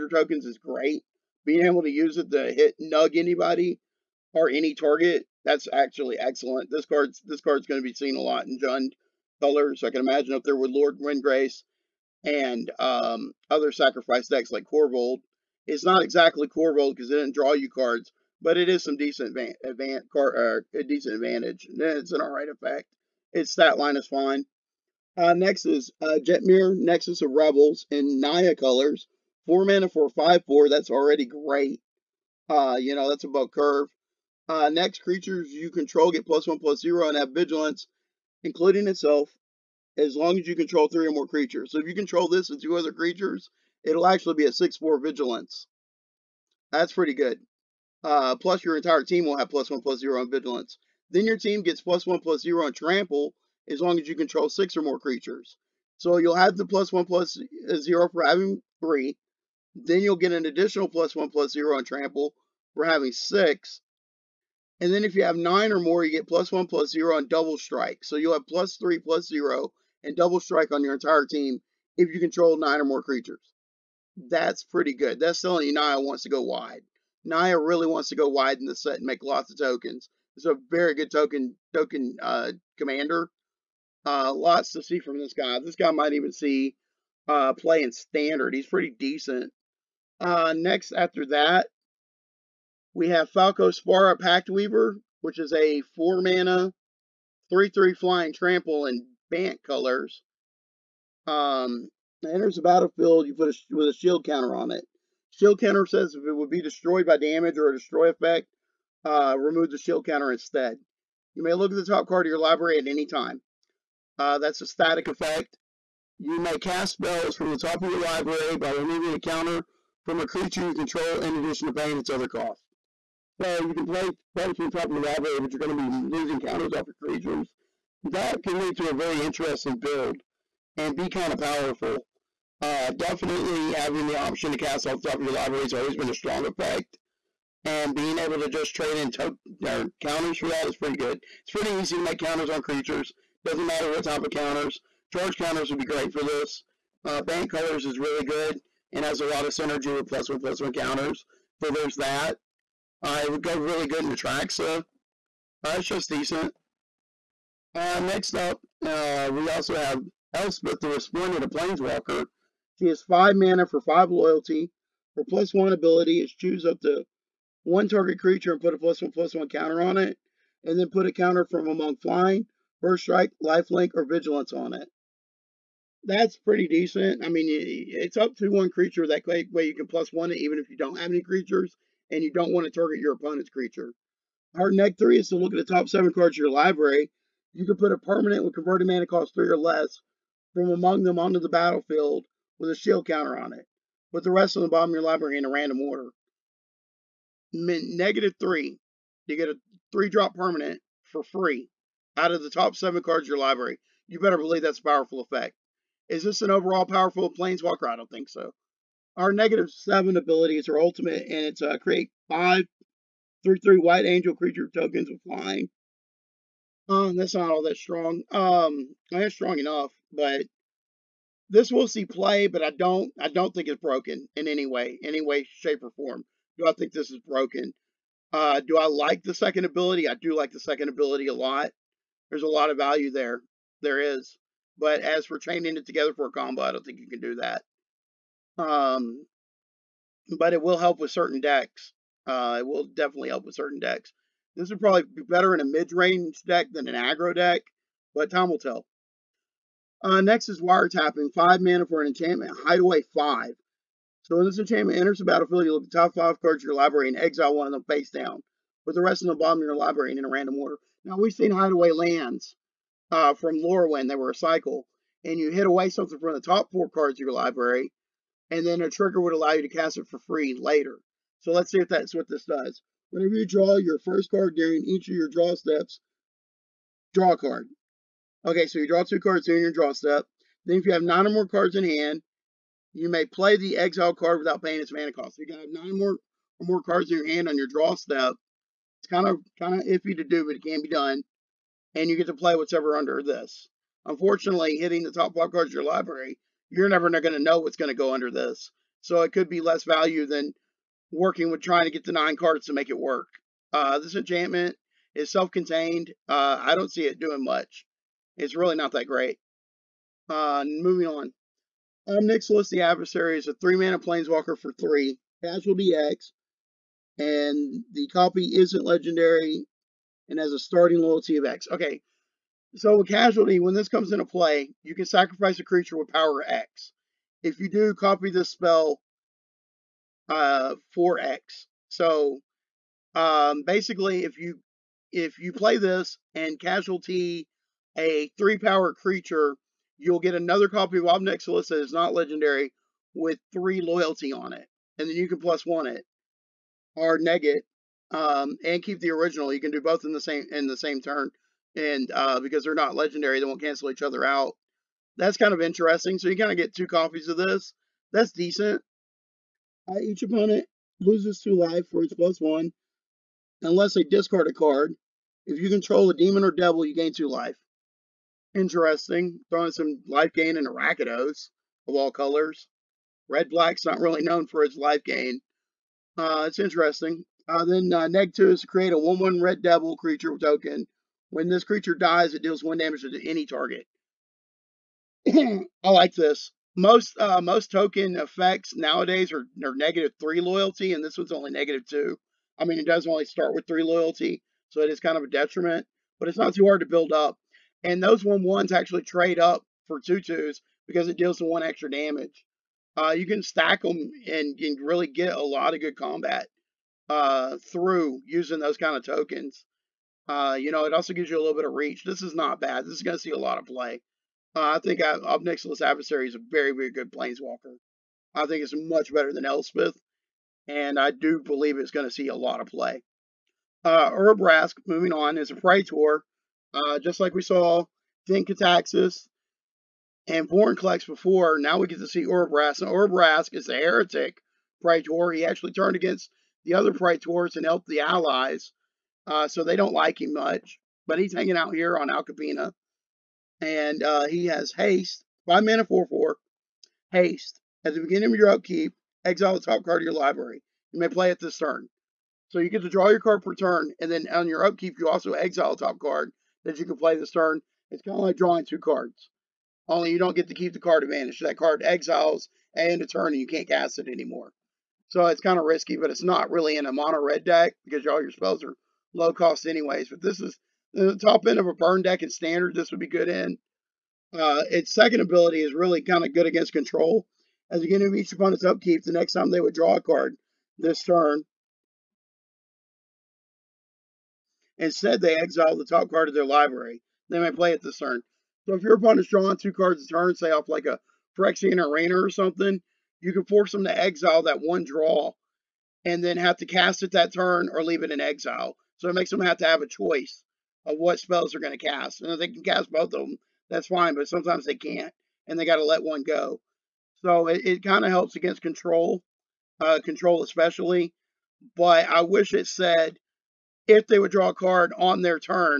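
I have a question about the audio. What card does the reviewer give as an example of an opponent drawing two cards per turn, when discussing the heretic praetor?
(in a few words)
Phyrexian Arena.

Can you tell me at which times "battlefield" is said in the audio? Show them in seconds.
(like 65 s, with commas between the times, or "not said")
102 s, 191 s, 255 s.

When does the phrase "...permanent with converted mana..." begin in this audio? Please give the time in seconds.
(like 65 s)
187 s.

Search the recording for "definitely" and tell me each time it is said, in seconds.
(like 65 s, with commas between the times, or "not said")
132 s, 242 s.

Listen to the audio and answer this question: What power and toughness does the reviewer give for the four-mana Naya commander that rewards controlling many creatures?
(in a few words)
5/4.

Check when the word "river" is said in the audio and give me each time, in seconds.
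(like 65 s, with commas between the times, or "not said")
not said.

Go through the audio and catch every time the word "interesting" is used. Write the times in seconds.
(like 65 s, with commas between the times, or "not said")
129 s, 355 s, 368 s, 376 s.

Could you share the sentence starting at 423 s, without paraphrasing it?
Uh, Urabrask, moving on, is a Praetor.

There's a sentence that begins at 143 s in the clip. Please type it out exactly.
Doesn't matter what type of counters.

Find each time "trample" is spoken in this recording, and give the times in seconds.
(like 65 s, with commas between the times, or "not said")
52 s, 61 s, 98 s.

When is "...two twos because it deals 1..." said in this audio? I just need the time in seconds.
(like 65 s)
399 s.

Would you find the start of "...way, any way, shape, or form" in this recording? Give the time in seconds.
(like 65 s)
224 s.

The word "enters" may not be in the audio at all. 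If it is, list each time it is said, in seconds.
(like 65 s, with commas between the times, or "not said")
102 s, 254 s.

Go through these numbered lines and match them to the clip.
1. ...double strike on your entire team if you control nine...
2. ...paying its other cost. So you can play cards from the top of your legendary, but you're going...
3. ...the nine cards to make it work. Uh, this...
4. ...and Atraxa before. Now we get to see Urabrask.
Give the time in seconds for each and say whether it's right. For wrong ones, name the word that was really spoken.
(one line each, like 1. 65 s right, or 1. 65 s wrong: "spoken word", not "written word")
1. 70 s right
2. 121 s wrong: "library", not "legendary"
3. 302 s right
4. 430 s wrong: "Vorinclex", not "Atraxa".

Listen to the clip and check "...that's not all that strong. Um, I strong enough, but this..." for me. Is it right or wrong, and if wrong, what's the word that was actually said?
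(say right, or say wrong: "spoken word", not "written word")
right.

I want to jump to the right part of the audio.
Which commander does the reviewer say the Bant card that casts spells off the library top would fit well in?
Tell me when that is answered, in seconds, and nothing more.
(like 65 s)
154 s.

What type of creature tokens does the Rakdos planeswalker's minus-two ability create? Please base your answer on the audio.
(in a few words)
red devil.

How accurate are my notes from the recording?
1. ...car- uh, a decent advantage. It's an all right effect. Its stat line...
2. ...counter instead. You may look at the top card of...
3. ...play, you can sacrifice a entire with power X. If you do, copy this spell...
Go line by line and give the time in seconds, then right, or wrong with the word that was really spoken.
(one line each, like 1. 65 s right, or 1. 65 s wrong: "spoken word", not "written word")
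1. 20 s right
2. 110 s right
3. 324 s wrong: "creature", not "entire".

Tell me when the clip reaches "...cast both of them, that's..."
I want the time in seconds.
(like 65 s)
502 s.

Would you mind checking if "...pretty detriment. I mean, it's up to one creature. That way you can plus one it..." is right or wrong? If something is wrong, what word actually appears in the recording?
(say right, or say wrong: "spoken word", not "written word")
wrong: "decent", not "detriment".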